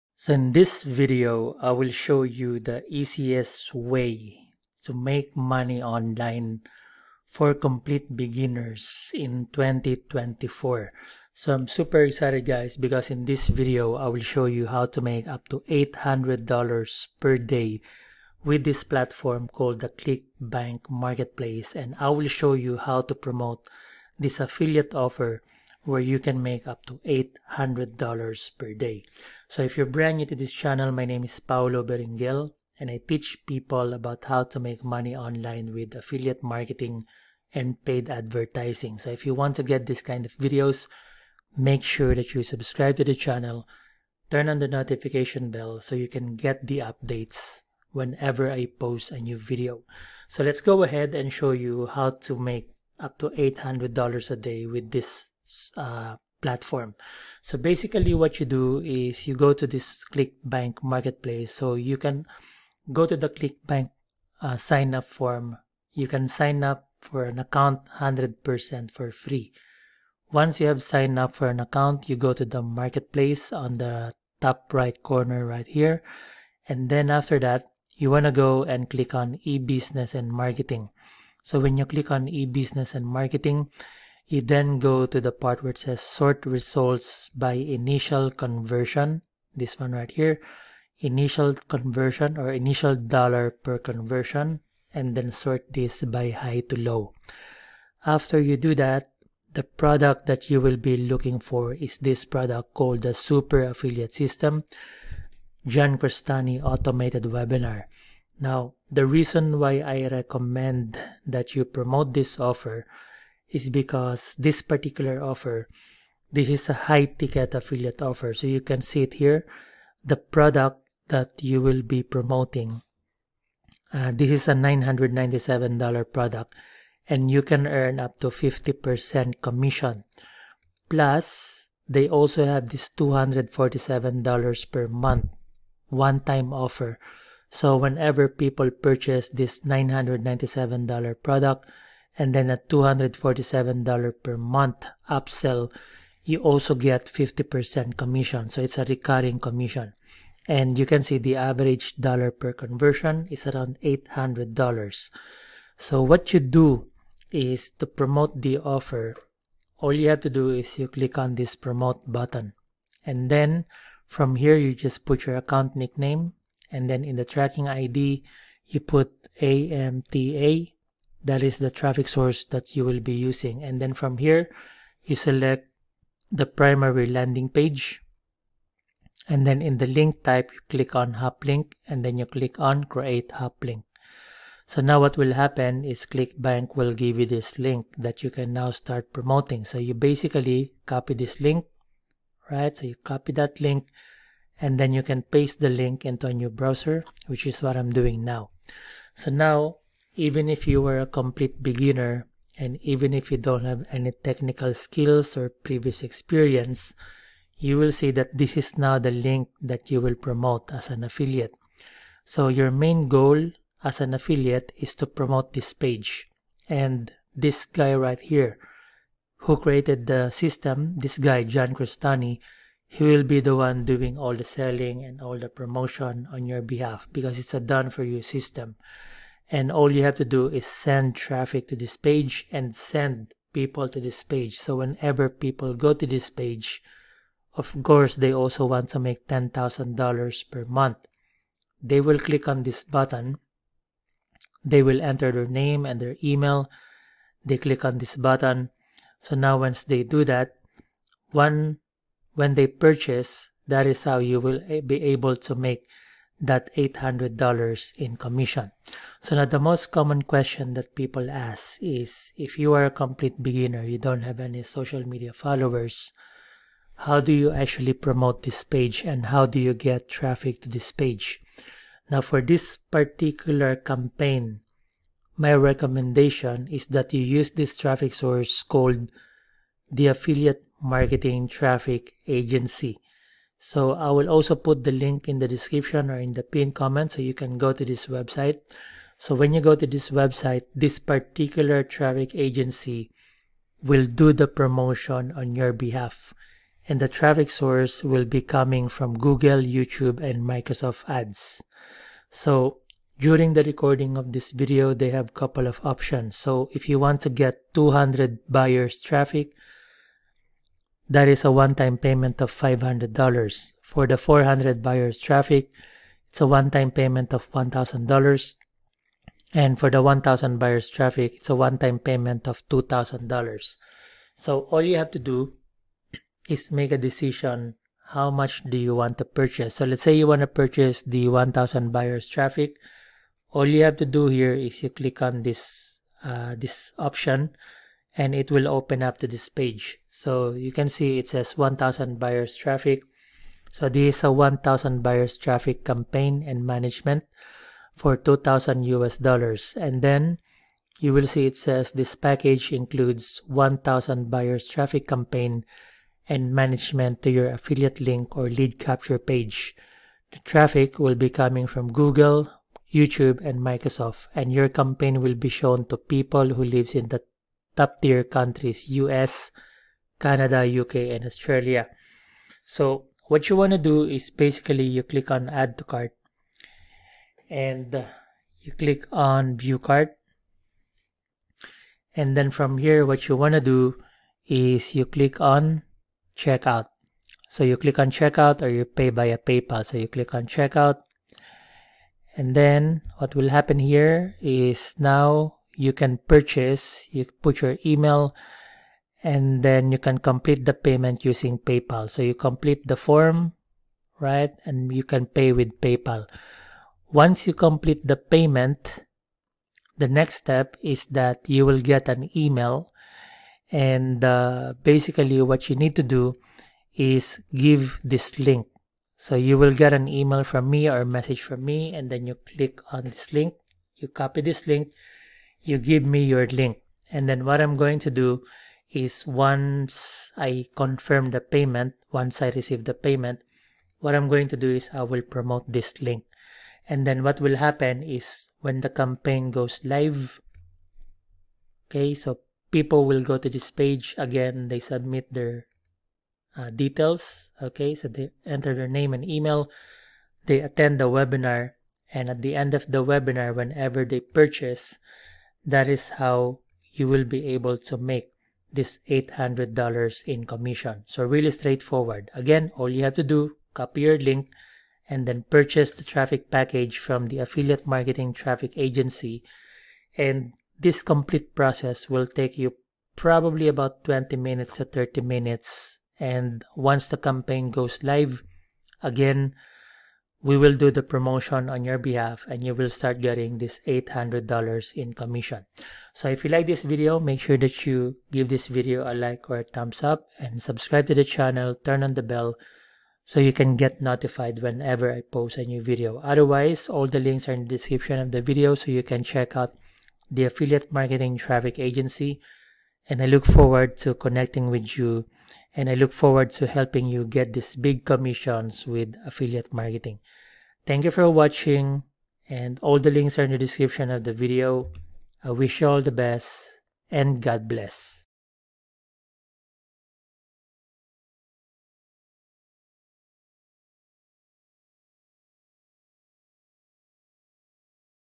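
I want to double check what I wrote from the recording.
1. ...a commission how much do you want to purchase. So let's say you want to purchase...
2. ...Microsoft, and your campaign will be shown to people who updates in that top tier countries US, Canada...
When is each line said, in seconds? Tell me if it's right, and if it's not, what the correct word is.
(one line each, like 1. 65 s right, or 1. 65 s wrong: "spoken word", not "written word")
1. 326 s wrong: "decision", not "commission"
2. 363 s wrong: "lives", not "updates".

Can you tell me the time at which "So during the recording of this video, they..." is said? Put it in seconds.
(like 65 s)
302 s.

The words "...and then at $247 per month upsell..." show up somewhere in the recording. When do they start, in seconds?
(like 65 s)
142 s.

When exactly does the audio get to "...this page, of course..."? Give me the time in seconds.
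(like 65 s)
236 s.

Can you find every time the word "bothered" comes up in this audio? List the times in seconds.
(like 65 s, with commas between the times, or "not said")
not said.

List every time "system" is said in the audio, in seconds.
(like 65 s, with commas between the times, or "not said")
104 s, 220 s, 228 s.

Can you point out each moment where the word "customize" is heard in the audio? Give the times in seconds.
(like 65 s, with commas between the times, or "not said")
not said.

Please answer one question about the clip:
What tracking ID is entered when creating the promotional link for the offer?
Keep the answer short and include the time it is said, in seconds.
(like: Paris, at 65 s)
amta, at 169 s.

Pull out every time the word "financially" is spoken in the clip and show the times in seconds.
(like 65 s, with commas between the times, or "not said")
not said.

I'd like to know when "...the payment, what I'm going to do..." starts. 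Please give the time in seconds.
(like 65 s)
432 s.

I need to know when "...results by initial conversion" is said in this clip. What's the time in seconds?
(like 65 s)
86 s.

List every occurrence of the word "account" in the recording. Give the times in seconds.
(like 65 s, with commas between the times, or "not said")
67 s, 71 s, 165 s.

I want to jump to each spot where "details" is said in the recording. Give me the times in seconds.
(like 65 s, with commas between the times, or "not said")
446 s.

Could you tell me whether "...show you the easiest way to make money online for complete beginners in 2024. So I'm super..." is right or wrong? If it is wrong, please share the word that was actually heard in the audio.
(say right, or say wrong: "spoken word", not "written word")
right.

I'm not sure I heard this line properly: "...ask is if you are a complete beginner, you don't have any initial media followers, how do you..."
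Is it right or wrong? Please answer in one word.
wrong.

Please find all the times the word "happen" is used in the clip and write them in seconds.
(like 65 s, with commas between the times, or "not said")
185 s, 393 s, 437 s.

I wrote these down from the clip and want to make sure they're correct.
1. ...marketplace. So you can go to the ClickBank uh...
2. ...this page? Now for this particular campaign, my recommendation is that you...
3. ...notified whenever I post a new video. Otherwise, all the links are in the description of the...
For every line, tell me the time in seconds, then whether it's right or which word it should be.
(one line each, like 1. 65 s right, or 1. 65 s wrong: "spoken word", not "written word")
1. 60 s right
2. 270 s right
3. 494 s right.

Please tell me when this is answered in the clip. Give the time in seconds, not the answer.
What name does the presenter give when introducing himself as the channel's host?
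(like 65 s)
31 s.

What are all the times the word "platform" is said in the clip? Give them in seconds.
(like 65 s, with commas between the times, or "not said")
18 s, 56 s.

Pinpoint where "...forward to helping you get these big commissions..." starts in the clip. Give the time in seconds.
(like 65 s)
506 s.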